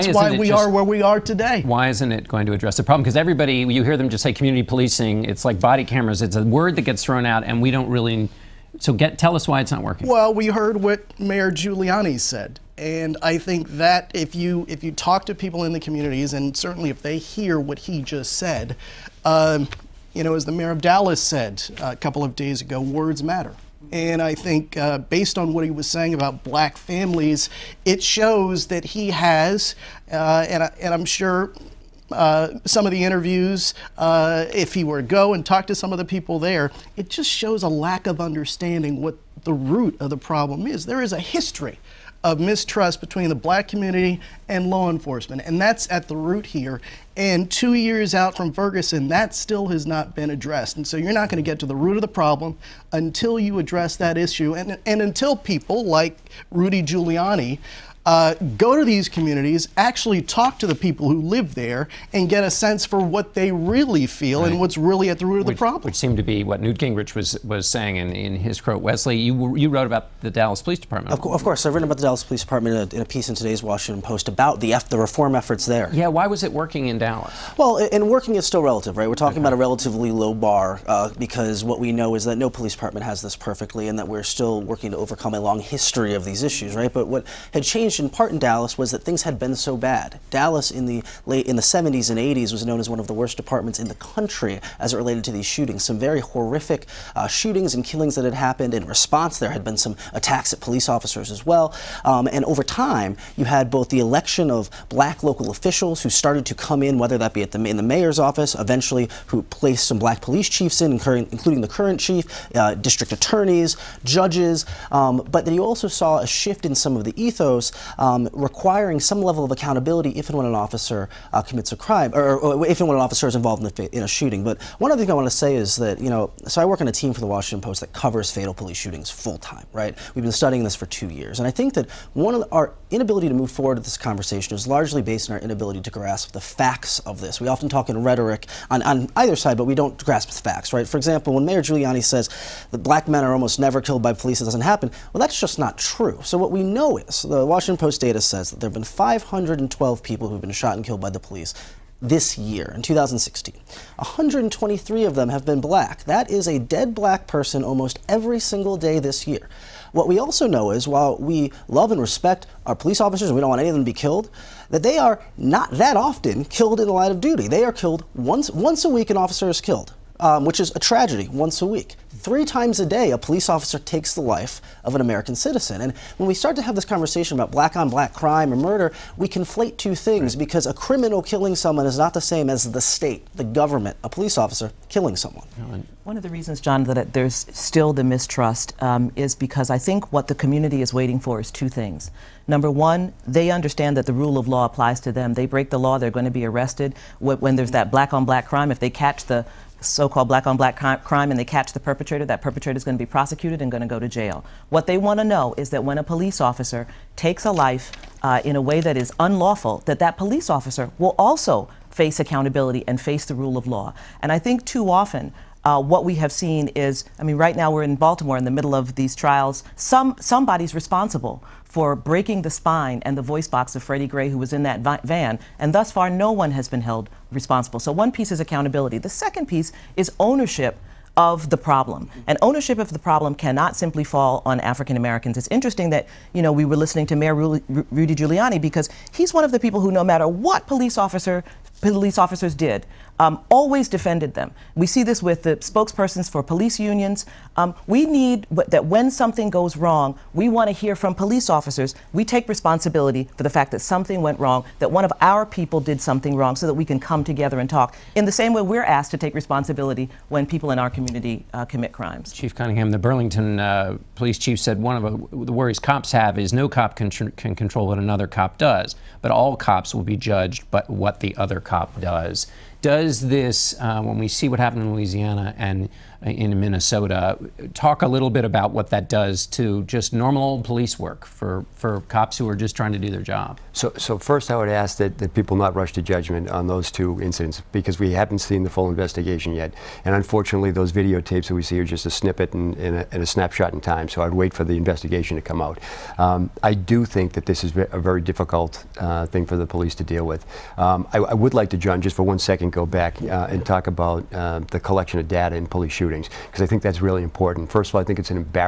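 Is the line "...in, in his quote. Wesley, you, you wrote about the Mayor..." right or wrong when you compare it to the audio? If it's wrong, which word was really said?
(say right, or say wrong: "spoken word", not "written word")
wrong: "Dallas", not "Mayor".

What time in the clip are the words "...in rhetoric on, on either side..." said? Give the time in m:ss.
2:17.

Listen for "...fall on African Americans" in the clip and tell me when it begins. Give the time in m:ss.
3:54.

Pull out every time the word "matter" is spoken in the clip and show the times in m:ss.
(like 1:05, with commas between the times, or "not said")
0:23, 4:00.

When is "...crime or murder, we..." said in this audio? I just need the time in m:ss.
2:58.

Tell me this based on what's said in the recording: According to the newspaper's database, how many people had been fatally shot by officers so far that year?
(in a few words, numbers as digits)
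512.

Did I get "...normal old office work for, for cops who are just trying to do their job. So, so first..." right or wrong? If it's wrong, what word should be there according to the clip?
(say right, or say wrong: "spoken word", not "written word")
wrong: "police", not "office".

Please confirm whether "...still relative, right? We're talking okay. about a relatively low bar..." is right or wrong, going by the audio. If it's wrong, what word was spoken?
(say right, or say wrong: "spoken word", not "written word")
right.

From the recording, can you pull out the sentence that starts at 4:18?
In the same way, we're asked to take responsibility when people in our community uh, commit crimes.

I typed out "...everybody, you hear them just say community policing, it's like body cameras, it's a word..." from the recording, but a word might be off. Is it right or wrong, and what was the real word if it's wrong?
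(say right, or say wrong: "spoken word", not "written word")
right.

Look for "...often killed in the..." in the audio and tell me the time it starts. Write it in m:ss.
2:45.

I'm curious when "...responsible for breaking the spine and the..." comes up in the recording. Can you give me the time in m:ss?
3:40.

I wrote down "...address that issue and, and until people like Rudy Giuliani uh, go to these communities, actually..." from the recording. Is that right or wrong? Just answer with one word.
right.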